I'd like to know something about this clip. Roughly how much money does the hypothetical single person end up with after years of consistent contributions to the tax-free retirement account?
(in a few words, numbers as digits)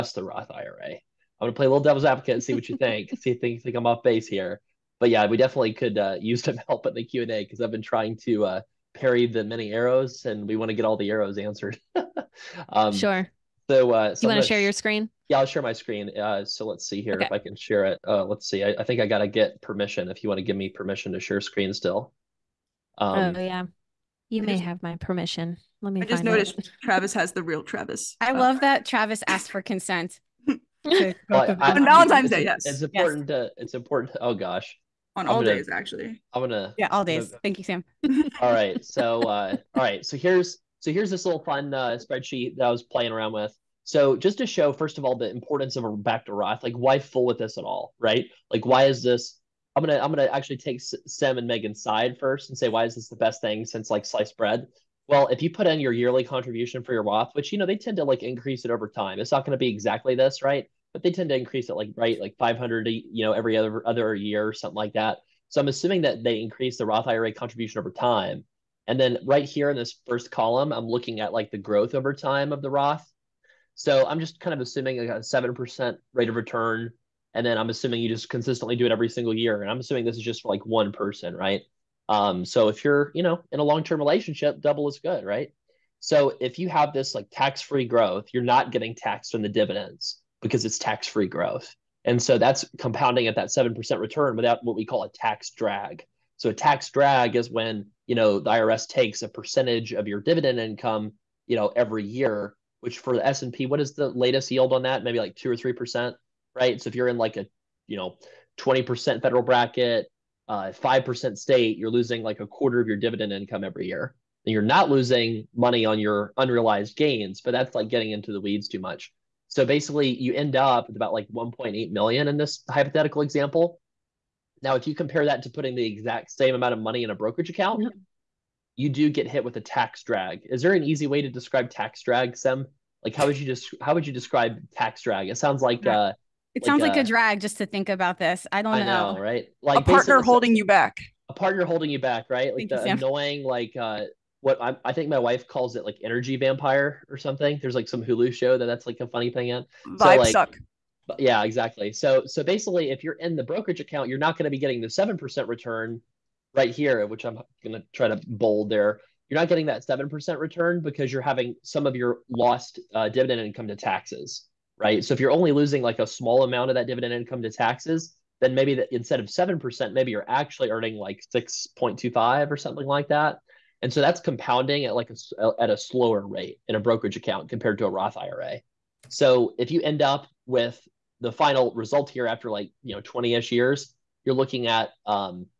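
1.8 million.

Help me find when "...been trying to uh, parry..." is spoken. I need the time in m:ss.
0:07.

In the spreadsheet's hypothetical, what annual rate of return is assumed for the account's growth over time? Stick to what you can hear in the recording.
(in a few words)
7%.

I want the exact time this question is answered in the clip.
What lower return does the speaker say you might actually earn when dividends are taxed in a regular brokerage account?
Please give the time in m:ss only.
2:51.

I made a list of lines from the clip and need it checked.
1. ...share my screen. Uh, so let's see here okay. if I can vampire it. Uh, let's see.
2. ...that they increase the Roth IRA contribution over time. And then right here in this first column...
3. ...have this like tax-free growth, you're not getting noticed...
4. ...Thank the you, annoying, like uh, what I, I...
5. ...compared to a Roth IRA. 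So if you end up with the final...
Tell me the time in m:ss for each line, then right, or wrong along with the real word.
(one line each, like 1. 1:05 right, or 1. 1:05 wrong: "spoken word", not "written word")
1. 0:15 wrong: "share", not "vampire"
2. 1:06 right
3. 1:26 wrong: "taxed", not "noticed"
4. 2:22 right
5. 2:57 right.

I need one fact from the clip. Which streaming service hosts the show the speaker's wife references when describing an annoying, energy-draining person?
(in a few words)
Hulu.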